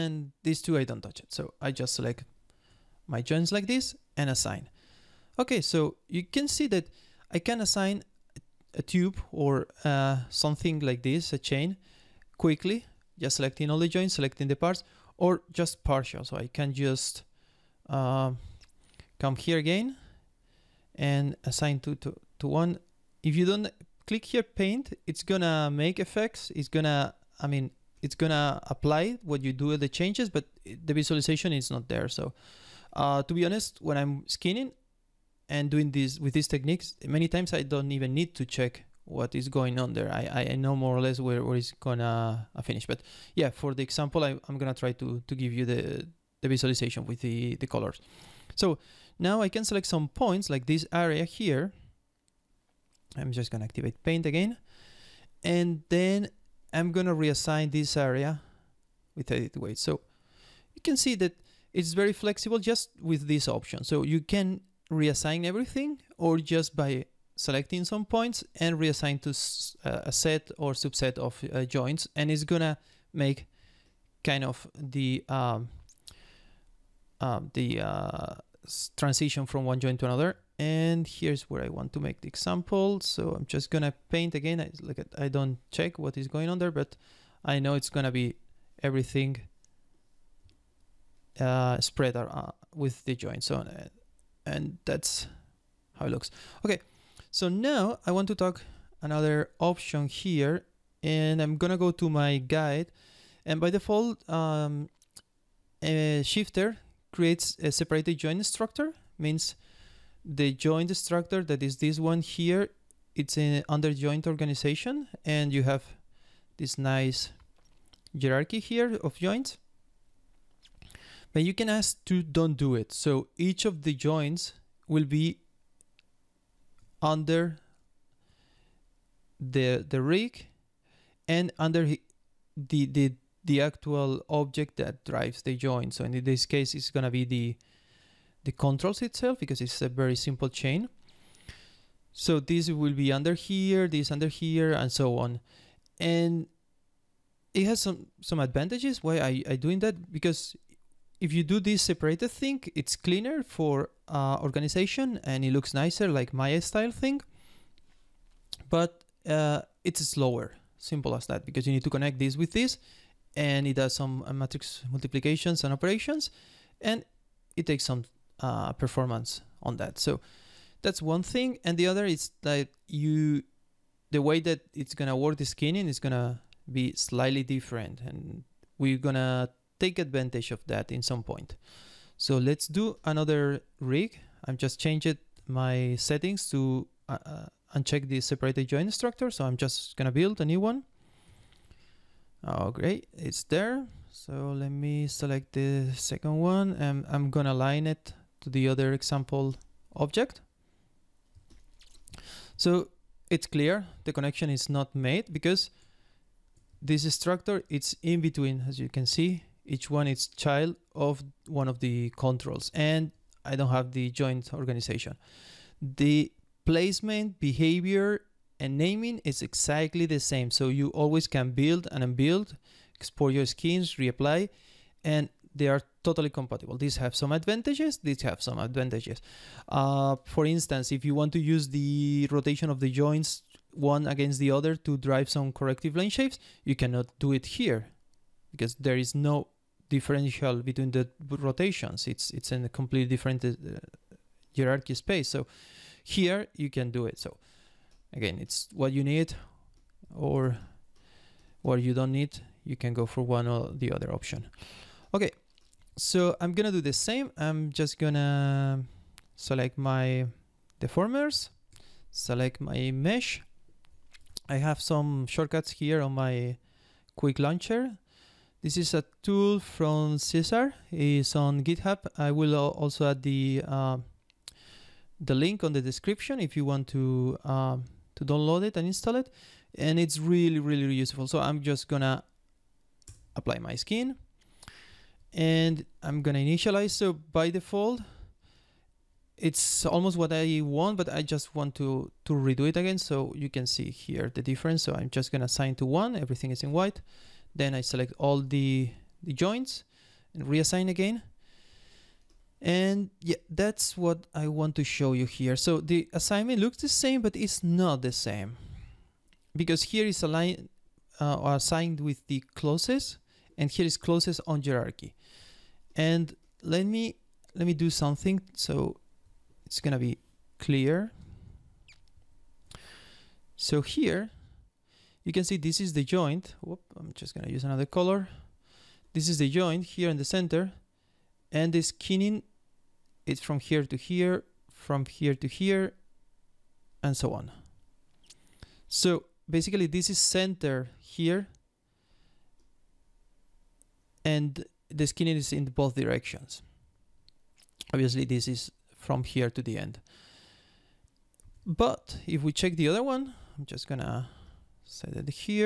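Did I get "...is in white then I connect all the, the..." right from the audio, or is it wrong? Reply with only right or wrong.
wrong.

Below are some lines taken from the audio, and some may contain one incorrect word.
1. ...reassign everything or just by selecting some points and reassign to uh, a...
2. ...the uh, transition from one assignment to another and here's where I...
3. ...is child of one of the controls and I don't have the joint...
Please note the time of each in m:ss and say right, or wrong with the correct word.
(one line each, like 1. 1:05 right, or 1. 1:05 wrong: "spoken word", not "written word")
1. 1:04 right
2. 1:17 wrong: "joint", not "assignment"
3. 3:30 right.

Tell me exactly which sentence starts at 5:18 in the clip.
So it's going to be clear.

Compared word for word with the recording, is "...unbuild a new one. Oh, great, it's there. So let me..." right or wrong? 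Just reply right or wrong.
wrong.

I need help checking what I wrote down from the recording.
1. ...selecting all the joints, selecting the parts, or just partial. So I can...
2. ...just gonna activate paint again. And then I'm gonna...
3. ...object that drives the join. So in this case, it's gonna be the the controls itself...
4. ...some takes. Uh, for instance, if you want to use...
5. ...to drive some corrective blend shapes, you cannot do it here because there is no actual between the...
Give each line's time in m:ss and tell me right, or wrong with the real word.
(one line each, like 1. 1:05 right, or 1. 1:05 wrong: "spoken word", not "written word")
1. 0:13 right
2. 0:53 right
3. 2:14 right
4. 3:48 wrong: "advantages", not "takes"
5. 3:54 wrong: "differential", not "actual".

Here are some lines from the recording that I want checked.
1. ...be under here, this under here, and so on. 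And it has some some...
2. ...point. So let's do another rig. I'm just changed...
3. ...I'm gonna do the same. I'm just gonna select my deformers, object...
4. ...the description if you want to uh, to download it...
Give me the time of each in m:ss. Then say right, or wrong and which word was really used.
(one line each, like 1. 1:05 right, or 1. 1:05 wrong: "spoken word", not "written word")
1. 2:22 right
2. 3:01 right
3. 4:16 wrong: "select", not "object"
4. 4:35 right.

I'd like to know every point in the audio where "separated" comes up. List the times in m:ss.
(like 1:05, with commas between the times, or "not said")
1:47, 2:31, 3:08.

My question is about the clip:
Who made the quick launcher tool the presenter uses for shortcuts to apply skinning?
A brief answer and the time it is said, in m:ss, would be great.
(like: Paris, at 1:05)
Cesar, at 4:30.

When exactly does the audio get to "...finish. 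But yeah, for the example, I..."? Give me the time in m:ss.
0:42.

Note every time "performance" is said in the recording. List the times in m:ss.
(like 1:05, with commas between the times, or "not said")
2:48.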